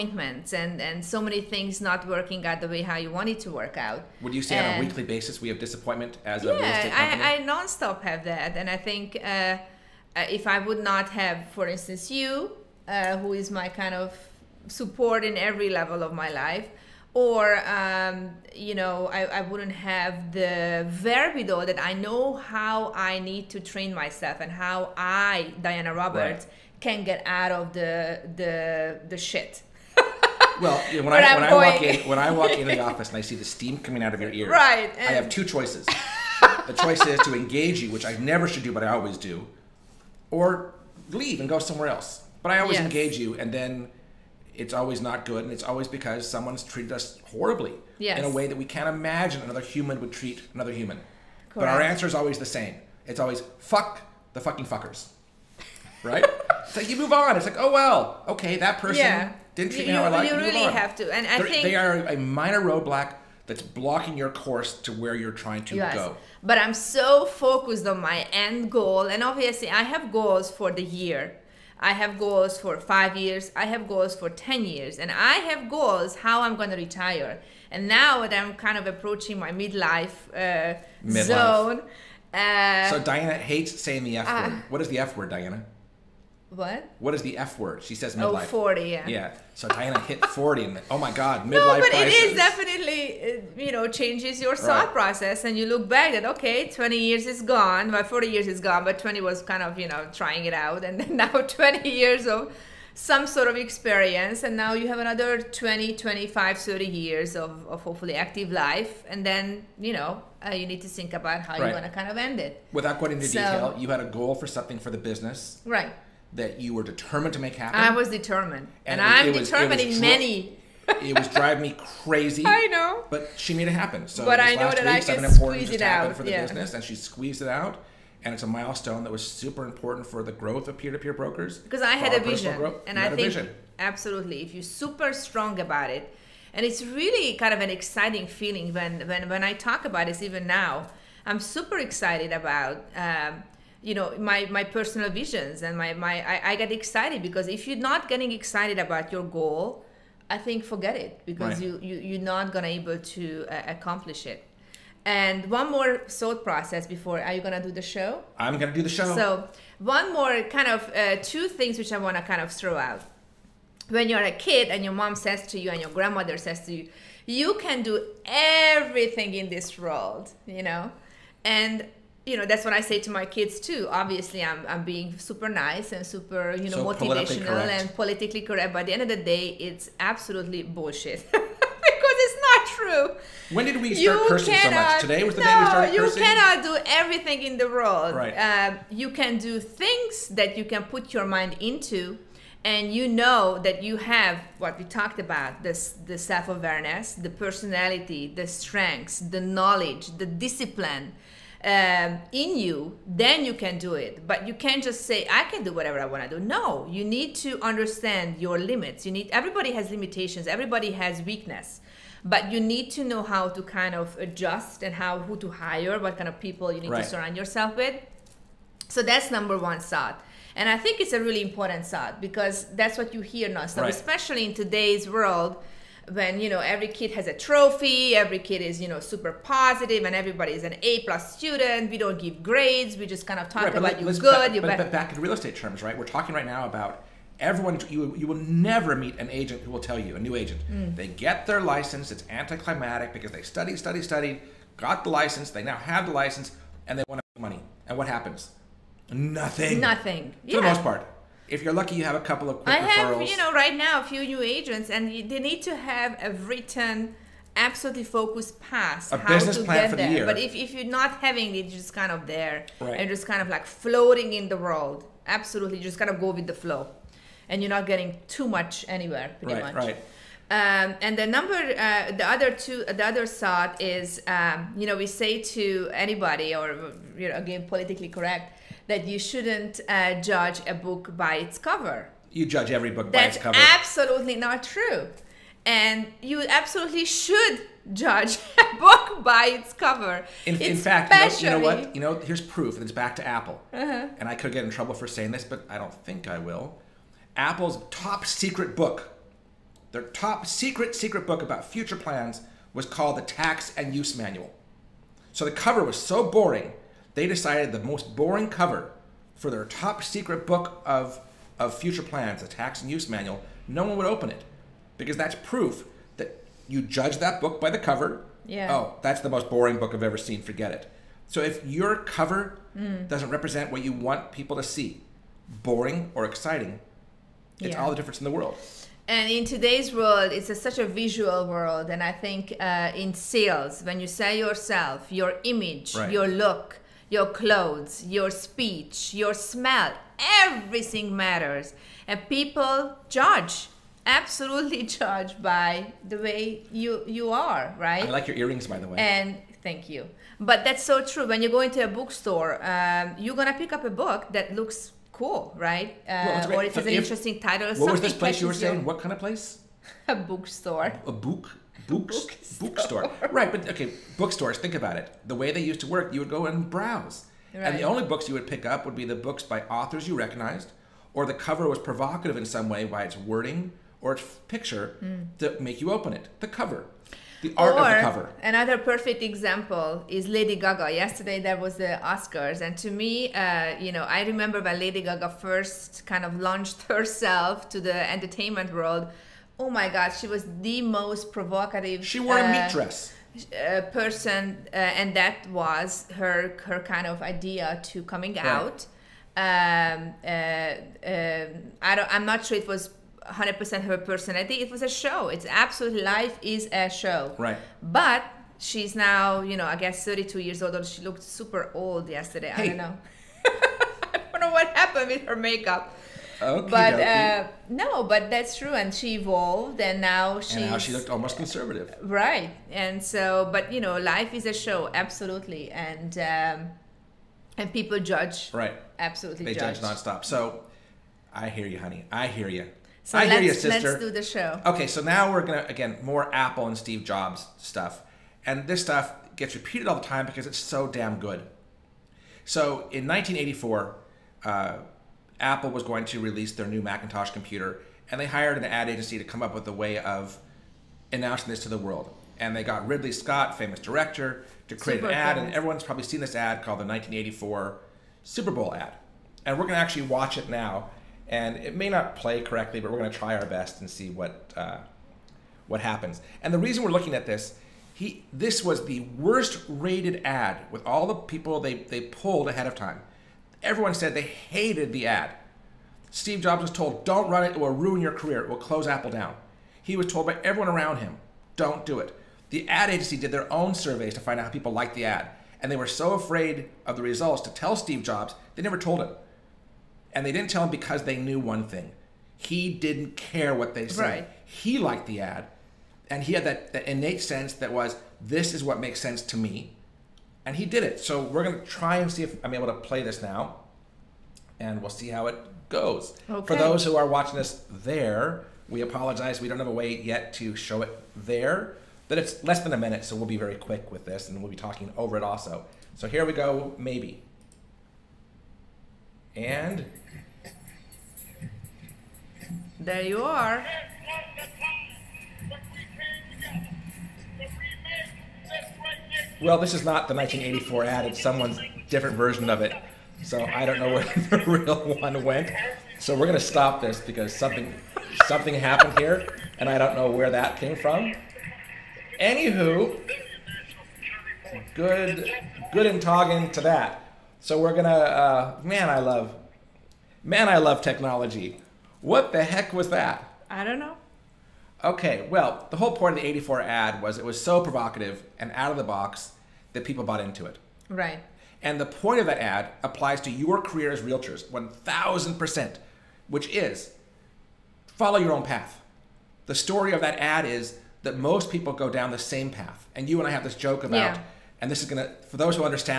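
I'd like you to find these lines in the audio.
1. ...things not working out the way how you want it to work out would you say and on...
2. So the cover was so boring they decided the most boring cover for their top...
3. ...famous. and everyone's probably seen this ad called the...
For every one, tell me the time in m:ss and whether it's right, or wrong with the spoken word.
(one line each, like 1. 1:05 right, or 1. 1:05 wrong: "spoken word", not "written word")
1. 0:01 right
2. 5:05 right
3. 7:35 right.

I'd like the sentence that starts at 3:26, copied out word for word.
No, you need to understand your limits.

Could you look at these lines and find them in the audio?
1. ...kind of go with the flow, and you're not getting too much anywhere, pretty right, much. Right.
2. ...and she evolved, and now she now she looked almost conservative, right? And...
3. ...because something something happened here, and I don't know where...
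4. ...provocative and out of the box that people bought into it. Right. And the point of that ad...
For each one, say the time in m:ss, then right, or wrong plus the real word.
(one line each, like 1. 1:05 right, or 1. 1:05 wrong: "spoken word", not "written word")
1. 4:25 right
2. 6:58 right
3. 8:57 right
4. 9:17 right.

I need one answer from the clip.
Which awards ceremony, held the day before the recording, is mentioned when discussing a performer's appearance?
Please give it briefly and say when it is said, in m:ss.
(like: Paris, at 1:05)
The Oscars, at 6:21.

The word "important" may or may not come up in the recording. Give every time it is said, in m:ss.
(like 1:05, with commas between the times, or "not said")
2:09, 3:41.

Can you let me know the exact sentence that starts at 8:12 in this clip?
He didn't care what they said.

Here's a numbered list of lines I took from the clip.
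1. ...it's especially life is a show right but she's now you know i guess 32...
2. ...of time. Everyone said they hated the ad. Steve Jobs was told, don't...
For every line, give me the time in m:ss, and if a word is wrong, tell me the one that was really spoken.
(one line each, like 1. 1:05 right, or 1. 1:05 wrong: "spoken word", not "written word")
1. 6:45 wrong: "absolutely", not "especially"
2. 7:52 right.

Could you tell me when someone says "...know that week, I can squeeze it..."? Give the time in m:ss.
2:04.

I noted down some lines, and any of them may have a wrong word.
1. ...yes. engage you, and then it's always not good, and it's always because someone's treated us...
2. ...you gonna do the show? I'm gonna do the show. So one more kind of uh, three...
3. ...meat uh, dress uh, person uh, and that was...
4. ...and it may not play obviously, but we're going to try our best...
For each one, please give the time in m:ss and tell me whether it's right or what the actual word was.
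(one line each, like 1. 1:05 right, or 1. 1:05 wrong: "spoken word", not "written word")
1. 0:42 right
2. 2:37 wrong: "two", not "three"
3. 6:32 right
4. 7:41 wrong: "correctly", not "obviously".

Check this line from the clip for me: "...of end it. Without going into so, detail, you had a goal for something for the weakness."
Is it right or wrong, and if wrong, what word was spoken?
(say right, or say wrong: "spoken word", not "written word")
wrong: "business", not "weakness".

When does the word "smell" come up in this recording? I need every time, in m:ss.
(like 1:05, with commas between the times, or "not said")
5:39.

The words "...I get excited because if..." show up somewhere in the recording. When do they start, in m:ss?
2:26.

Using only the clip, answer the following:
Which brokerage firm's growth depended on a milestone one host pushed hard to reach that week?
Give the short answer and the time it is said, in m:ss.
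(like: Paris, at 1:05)
Peer-to-peer brokers, at 2:10.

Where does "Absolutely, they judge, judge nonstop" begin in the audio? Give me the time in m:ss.
7:08.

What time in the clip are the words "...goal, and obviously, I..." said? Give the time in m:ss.
1:08.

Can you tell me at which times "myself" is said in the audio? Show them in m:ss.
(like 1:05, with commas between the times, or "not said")
0:23.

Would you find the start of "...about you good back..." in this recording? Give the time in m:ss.
3:53.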